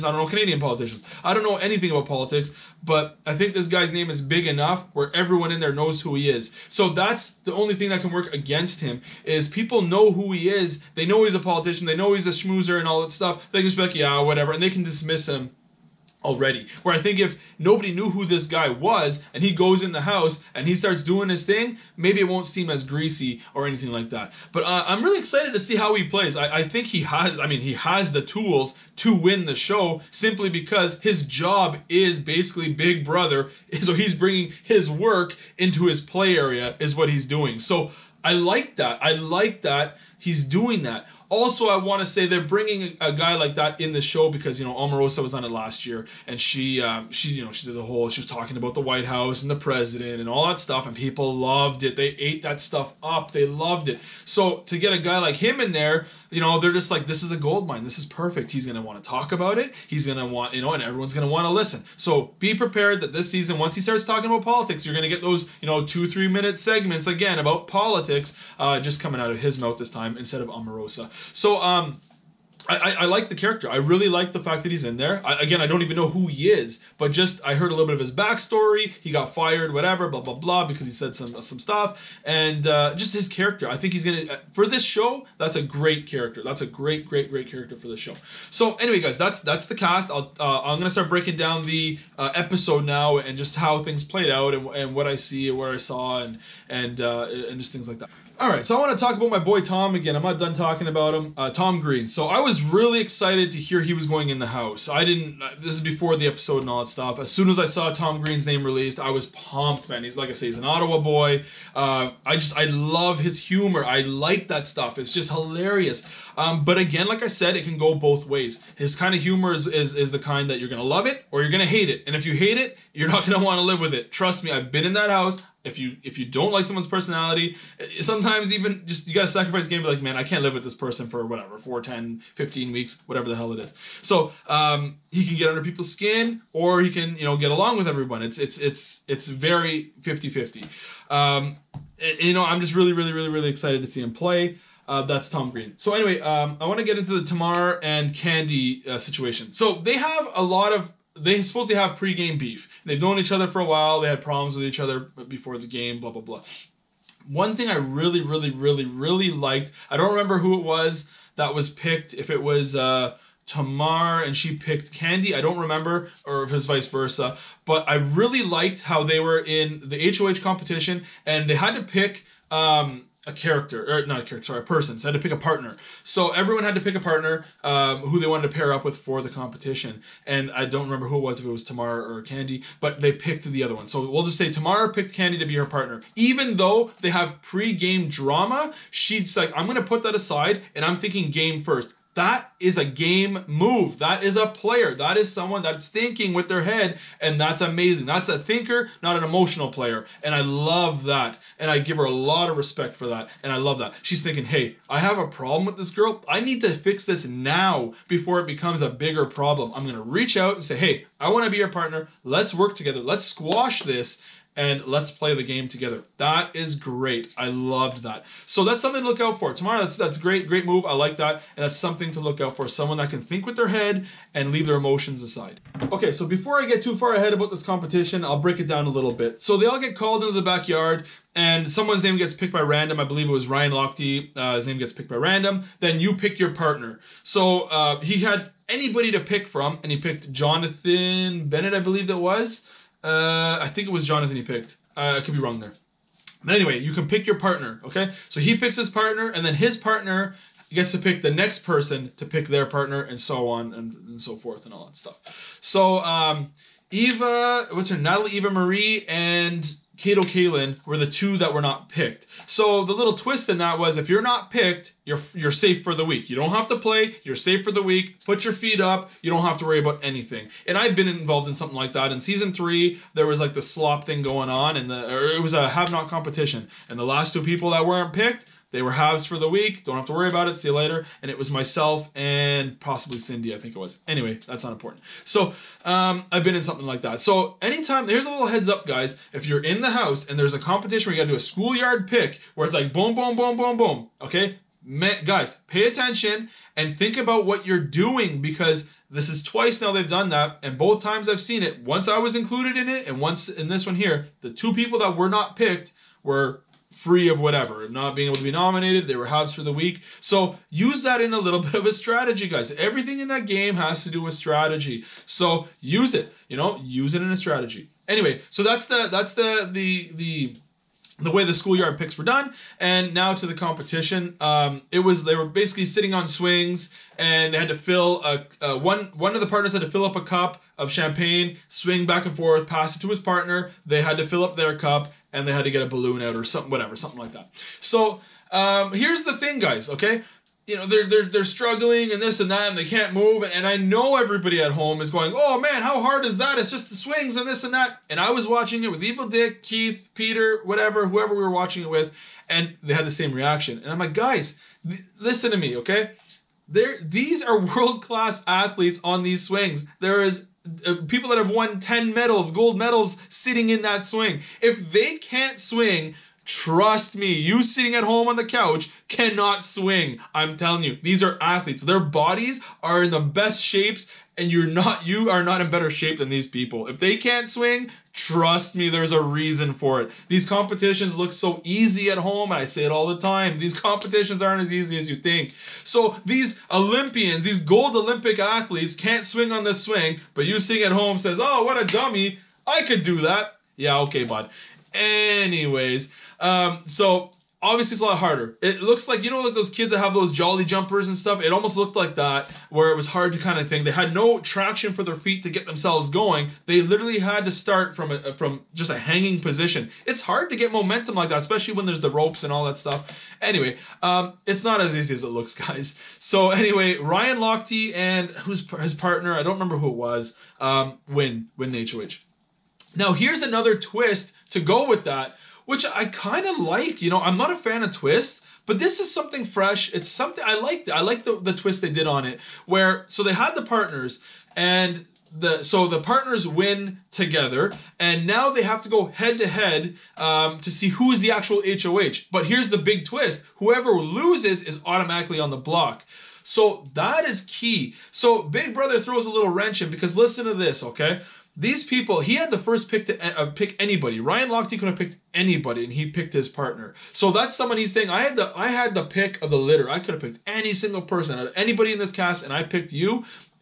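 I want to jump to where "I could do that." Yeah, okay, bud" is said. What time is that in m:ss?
6:32.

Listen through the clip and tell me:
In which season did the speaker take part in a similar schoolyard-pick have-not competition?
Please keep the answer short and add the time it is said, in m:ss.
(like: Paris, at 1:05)
Season 3, at 4:32.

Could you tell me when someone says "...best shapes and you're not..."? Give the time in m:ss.
6:13.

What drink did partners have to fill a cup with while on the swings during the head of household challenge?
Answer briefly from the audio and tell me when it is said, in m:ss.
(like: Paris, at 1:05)
Champagne, at 5:30.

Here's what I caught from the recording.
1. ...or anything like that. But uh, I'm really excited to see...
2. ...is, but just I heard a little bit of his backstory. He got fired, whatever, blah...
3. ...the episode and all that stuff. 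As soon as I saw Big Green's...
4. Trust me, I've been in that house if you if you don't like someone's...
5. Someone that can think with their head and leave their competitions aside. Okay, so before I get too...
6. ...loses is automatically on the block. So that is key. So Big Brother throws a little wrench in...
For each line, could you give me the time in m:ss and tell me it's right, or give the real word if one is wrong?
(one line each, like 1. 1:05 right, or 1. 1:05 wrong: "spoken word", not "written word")
1. 0:23 right
2. 1:16 right
3. 1:46 wrong: "Tom", not "Big"
4. 2:04 right
5. 3:42 wrong: "emotions", not "competitions"
6. 7:23 right.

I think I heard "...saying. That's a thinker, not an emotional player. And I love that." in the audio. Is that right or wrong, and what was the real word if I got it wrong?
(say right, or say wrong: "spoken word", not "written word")
wrong: "amazing", not "saying".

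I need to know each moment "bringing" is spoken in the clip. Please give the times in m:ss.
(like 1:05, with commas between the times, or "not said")
0:34, 0:42.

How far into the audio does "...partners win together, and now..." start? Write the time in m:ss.
7:15.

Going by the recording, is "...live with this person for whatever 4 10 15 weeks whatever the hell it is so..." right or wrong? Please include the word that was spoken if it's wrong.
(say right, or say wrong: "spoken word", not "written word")
right.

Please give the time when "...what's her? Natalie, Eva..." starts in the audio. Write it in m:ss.
4:17.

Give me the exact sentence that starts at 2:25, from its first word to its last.
So anyway, um, I want to get into the Tamar and Kandi uh, situation.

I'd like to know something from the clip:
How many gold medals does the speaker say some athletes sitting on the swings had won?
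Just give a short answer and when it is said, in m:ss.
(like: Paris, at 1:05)
10, at 6:01.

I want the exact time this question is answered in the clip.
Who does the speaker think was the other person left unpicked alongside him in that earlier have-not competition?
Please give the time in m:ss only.
4:43.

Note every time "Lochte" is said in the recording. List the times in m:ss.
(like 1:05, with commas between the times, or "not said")
3:53, 6:57, 7:34.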